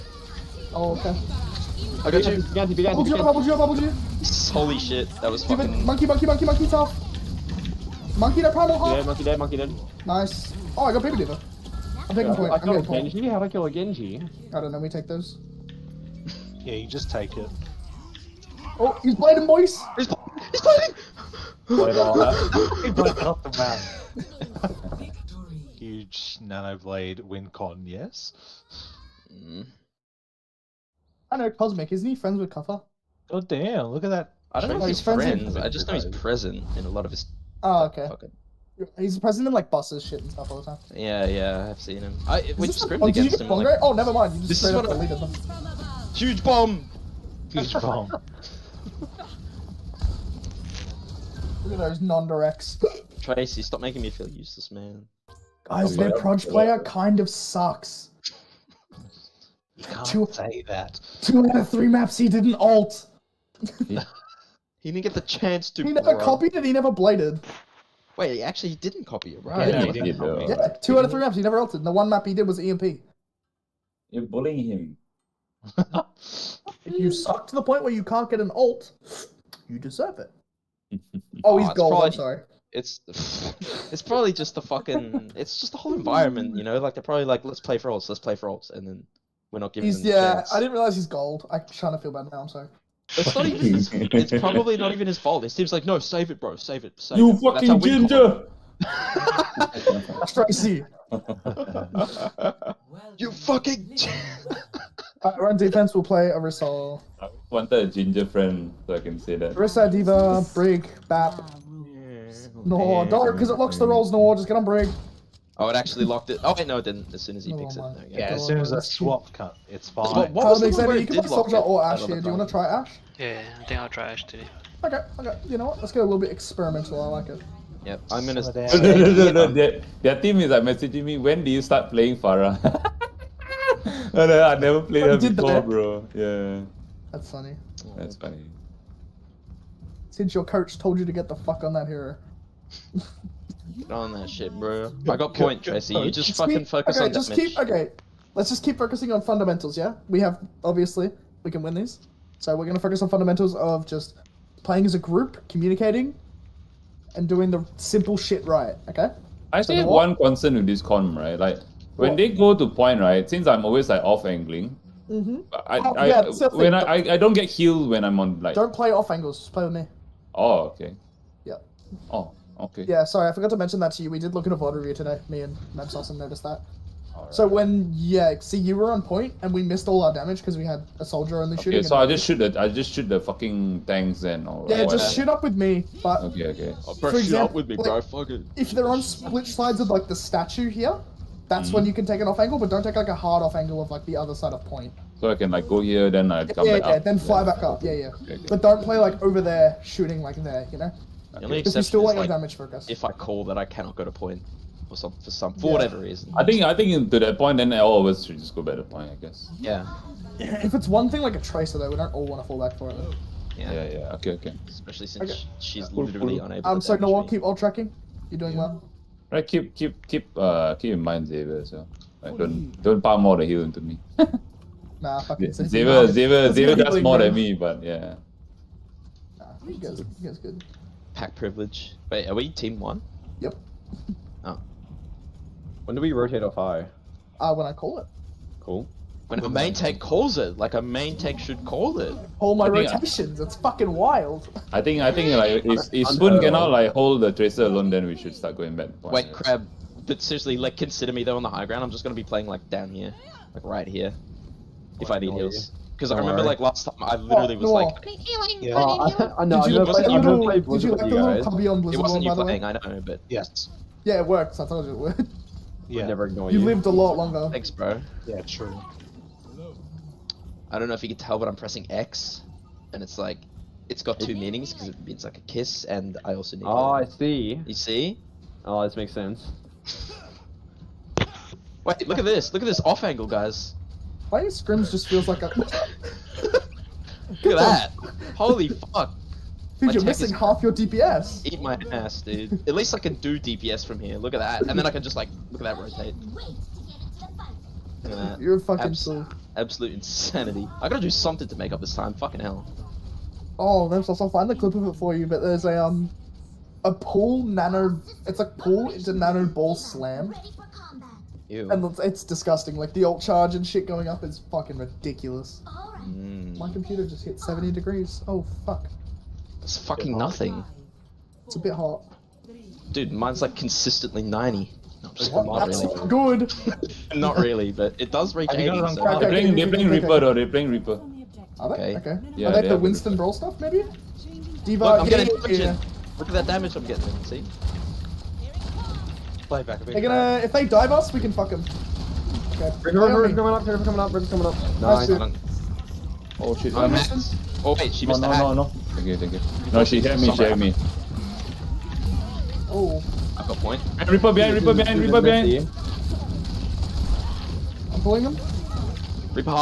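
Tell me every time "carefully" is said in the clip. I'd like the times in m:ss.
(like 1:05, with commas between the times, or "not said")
not said.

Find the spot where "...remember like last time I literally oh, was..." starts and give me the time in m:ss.
4:16.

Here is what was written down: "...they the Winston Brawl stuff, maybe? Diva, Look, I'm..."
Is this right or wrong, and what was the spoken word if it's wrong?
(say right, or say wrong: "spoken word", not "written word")
right.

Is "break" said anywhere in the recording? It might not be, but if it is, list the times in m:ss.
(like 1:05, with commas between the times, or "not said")
1:50.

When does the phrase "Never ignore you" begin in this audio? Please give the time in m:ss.
4:26.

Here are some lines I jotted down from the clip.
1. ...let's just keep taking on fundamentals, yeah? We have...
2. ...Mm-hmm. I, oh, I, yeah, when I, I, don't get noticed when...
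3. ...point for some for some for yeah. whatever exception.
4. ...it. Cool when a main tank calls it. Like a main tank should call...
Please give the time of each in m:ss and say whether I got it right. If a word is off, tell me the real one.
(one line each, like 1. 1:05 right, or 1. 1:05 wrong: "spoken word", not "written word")
1. 2:28 wrong: "focusing", not "taking"
2. 2:45 wrong: "healed", not "noticed"
3. 3:24 wrong: "reason", not "exception"
4. 3:57 right.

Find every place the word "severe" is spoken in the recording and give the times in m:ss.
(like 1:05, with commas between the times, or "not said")
not said.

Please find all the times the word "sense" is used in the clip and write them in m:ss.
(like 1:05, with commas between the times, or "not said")
4:39.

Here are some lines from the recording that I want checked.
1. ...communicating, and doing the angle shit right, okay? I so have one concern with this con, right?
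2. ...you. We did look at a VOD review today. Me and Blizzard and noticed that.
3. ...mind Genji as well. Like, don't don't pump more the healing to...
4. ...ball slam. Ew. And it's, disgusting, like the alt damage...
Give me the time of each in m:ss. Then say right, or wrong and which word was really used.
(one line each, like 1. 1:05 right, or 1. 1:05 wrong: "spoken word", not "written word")
1. 2:35 wrong: "simple", not "angle"
2. 2:54 wrong: "Nemsos", not "Blizzard"
3. 3:41 wrong: "Xavier", not "Genji"
4. 5:09 wrong: "charge", not "damage".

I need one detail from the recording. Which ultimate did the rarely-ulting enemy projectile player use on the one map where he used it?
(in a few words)
EMP.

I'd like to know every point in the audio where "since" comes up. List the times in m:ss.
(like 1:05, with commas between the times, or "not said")
2:20, 2:43, 3:35.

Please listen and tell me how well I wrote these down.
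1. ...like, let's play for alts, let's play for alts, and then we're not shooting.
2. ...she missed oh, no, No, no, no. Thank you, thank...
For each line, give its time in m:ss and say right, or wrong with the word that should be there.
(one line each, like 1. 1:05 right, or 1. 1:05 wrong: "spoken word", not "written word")
1. 1:27 wrong: "giving", not "shooting"
2. 5:47 right.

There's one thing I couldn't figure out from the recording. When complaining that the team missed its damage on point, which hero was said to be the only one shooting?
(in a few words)
Soldier.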